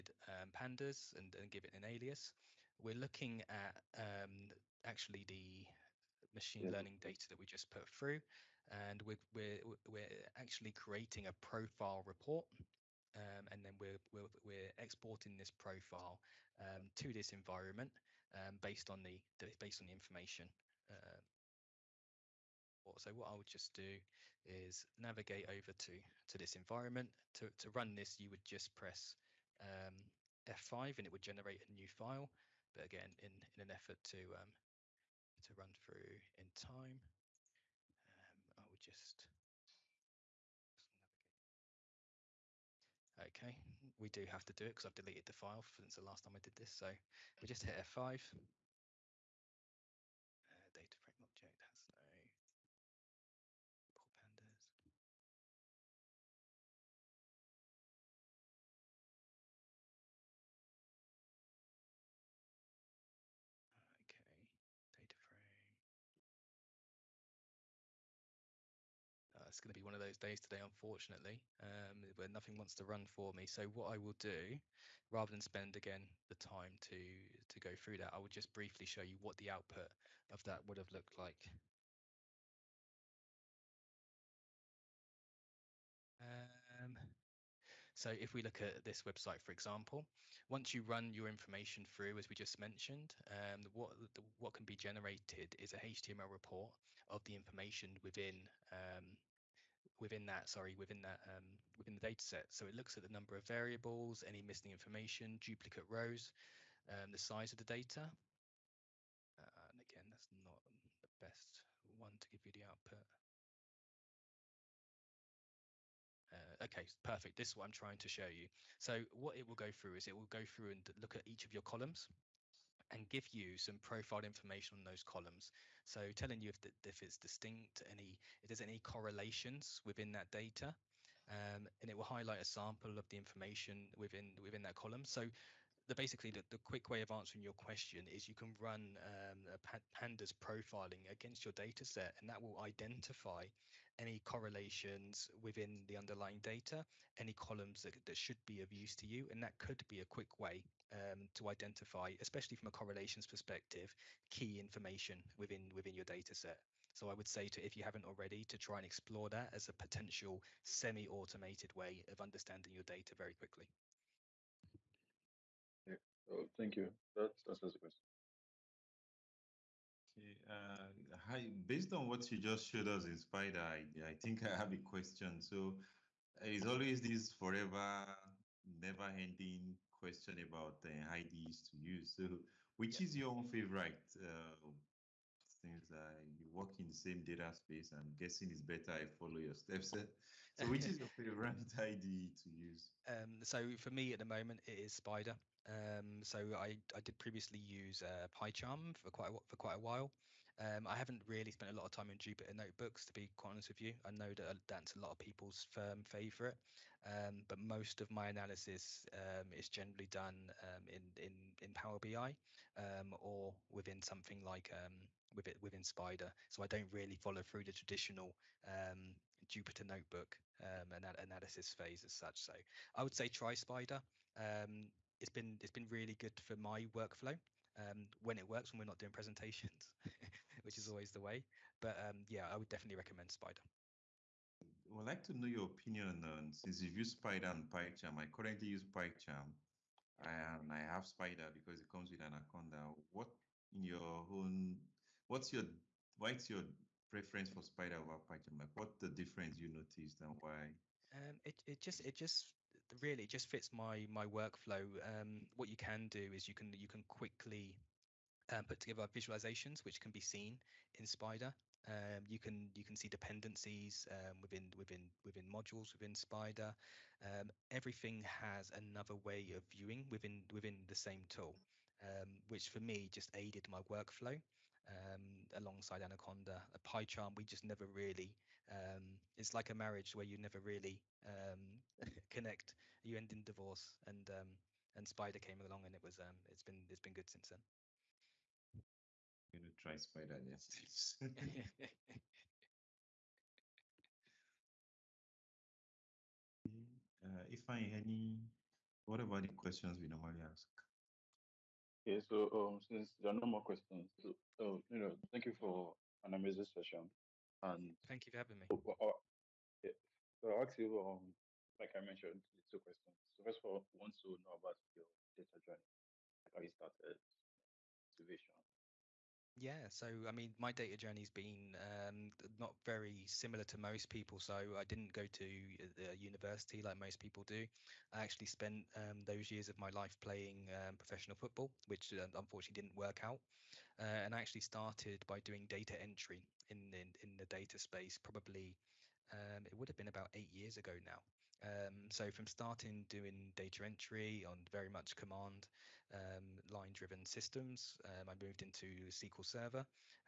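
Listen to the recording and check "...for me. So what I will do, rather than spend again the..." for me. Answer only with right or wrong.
right.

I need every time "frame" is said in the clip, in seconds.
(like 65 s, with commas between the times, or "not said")
50 s, 65 s.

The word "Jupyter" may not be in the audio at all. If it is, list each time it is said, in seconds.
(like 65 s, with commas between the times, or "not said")
202 s, 219 s.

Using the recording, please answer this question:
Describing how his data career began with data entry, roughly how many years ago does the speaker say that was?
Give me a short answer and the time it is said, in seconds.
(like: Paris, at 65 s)
8 years, at 340 s.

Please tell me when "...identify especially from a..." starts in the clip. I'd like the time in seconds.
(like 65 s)
151 s.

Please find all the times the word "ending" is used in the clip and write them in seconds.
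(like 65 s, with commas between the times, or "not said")
178 s.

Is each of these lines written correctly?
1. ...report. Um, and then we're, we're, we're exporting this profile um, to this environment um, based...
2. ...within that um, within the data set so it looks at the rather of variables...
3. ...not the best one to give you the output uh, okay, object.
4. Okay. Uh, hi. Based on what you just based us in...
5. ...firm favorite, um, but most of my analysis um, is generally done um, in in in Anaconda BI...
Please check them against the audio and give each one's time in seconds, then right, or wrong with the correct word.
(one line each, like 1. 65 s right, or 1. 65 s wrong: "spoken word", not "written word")
1. 12 s right
2. 100 s wrong: "number", not "rather"
3. 110 s wrong: "perfect", not "object"
4. 170 s wrong: "showed", not "based"
5. 205 s wrong: "Power", not "Anaconda".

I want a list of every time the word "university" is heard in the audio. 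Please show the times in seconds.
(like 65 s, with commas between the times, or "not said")
326 s.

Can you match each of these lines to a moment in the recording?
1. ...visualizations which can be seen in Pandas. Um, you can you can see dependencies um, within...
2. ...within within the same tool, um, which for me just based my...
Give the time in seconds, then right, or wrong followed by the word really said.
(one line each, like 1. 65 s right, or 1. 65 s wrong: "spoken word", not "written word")
1. 259 s wrong: "Spyder", not "Pandas"
2. 270 s wrong: "aided", not "based".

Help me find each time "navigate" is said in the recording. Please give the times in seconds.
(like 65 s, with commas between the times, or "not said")
24 s, 43 s.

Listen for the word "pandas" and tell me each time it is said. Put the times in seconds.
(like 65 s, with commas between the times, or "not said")
0 s, 54 s, 139 s.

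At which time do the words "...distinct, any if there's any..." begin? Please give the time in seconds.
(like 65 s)
127 s.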